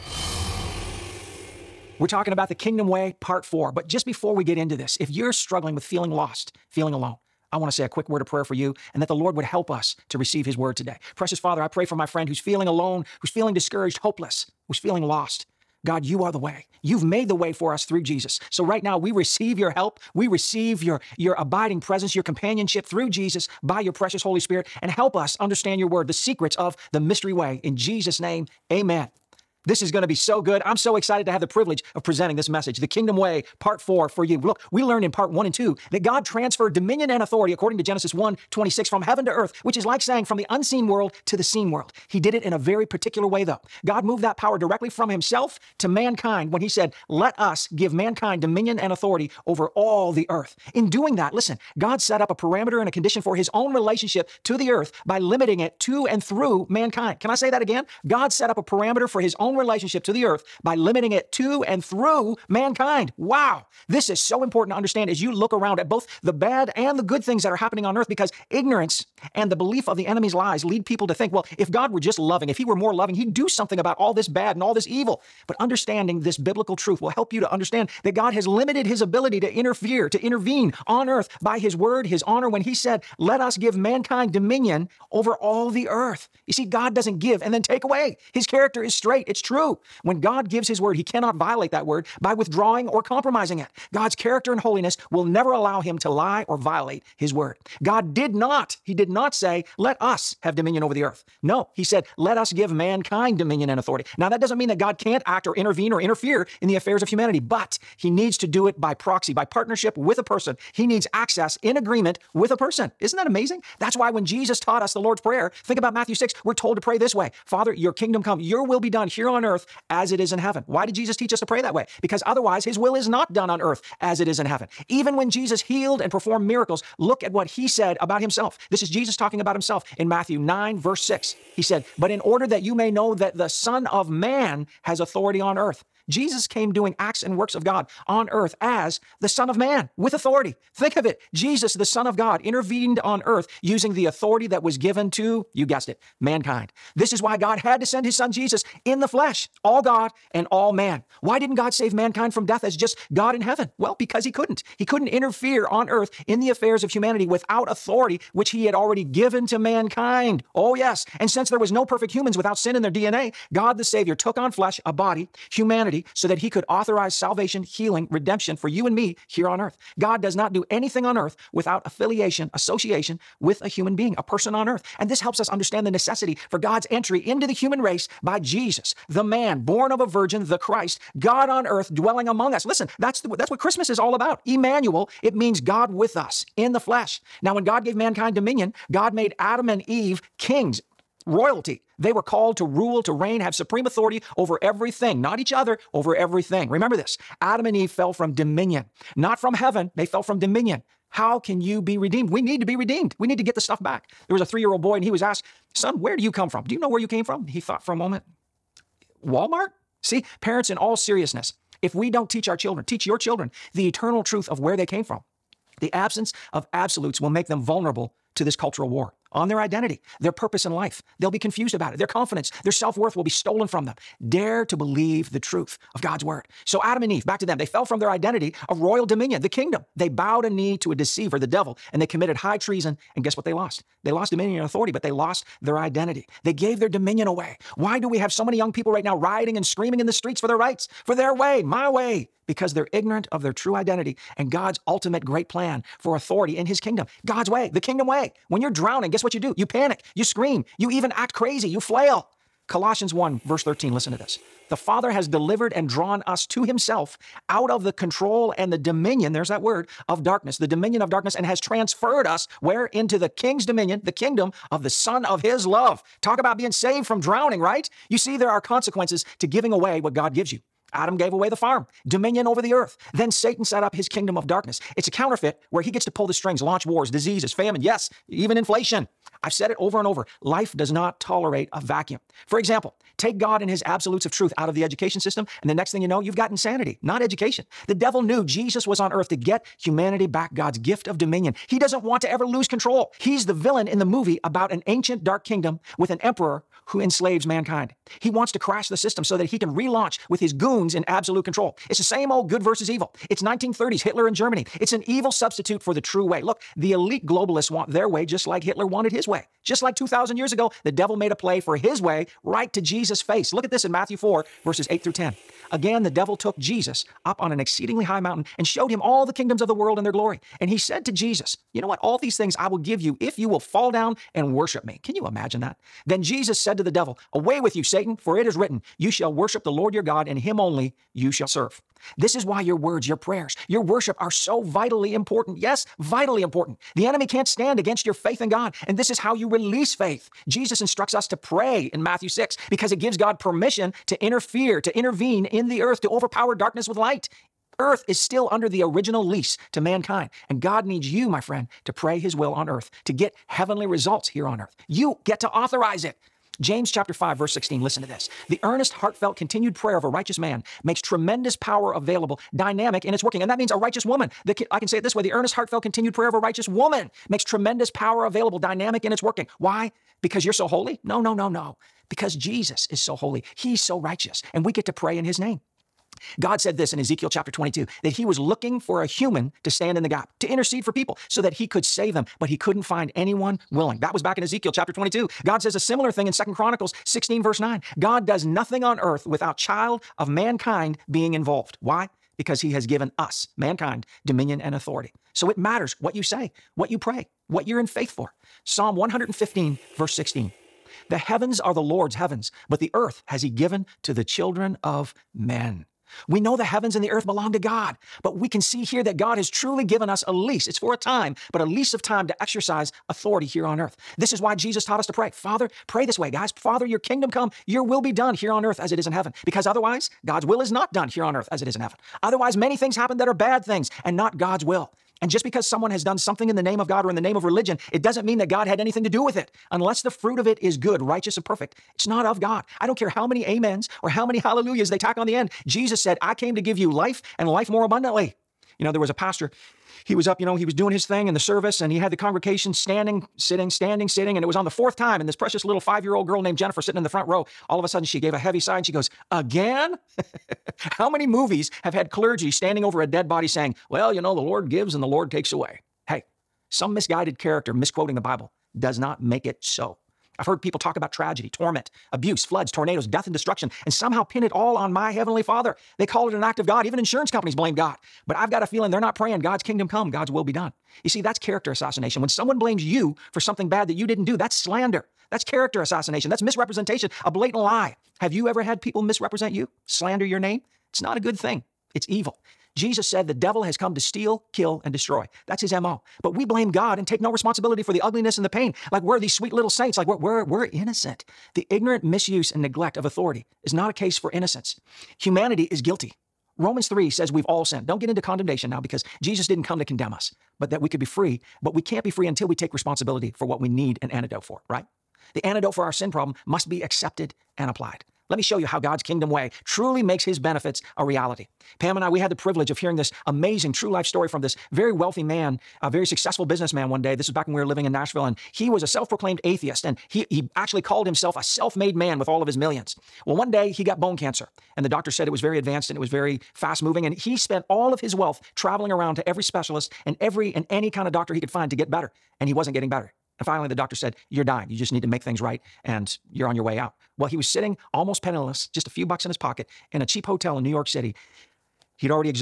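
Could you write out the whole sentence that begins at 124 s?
Even when Jesus healed and performed miracles, look at what he said about himself.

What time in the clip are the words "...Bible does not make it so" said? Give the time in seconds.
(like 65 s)
458 s.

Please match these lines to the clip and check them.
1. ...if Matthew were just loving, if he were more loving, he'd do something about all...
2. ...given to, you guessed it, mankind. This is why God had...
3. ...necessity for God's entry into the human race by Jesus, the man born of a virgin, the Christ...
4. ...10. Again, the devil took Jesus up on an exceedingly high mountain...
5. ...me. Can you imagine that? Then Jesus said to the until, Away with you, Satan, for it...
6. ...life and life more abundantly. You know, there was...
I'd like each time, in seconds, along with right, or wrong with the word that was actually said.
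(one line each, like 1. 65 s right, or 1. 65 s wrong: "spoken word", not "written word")
1. 71 s wrong: "God", not "Matthew"
2. 144 s right
3. 175 s right
4. 315 s right
5. 324 s wrong: "devil", not "until"
6. 436 s right.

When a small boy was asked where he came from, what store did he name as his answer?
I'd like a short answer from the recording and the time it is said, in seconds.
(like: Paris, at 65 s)
Walmart, at 209 s.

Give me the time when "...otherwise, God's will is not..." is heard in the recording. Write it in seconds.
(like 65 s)
419 s.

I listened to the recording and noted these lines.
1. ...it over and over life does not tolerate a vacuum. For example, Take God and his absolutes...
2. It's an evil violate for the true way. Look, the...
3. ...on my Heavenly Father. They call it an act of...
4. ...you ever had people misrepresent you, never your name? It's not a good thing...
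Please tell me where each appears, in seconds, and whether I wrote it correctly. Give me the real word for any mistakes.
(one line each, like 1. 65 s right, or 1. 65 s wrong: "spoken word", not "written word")
1. 279 s right
2. 304 s wrong: "substitute", not "violate"
3. 464 s right
4. 478 s wrong: "slander", not "never".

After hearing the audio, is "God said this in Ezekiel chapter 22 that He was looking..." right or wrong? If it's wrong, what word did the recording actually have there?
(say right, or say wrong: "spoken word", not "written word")
right.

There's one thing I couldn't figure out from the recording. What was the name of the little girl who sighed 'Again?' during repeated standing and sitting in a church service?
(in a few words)
Jennifer.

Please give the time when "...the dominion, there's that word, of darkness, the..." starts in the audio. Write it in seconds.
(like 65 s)
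258 s.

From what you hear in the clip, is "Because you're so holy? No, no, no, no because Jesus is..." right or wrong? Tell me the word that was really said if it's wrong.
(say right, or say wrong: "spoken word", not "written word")
right.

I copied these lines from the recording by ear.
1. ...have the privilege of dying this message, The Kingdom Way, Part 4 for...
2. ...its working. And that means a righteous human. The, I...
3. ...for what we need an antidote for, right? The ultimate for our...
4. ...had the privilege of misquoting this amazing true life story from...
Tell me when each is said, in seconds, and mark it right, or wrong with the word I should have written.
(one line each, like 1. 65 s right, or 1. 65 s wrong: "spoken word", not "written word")
1. 31 s wrong: "presenting", not "dying"
2. 363 s wrong: "woman", not "human"
3. 503 s wrong: "antidote", not "ultimate"
4. 512 s wrong: "hearing", not "misquoting".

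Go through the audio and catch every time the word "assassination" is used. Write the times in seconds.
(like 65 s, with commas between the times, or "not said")
471 s, 475 s.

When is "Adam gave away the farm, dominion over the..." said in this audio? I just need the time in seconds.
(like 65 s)
270 s.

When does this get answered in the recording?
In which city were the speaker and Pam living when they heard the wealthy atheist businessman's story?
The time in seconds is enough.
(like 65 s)
517 s.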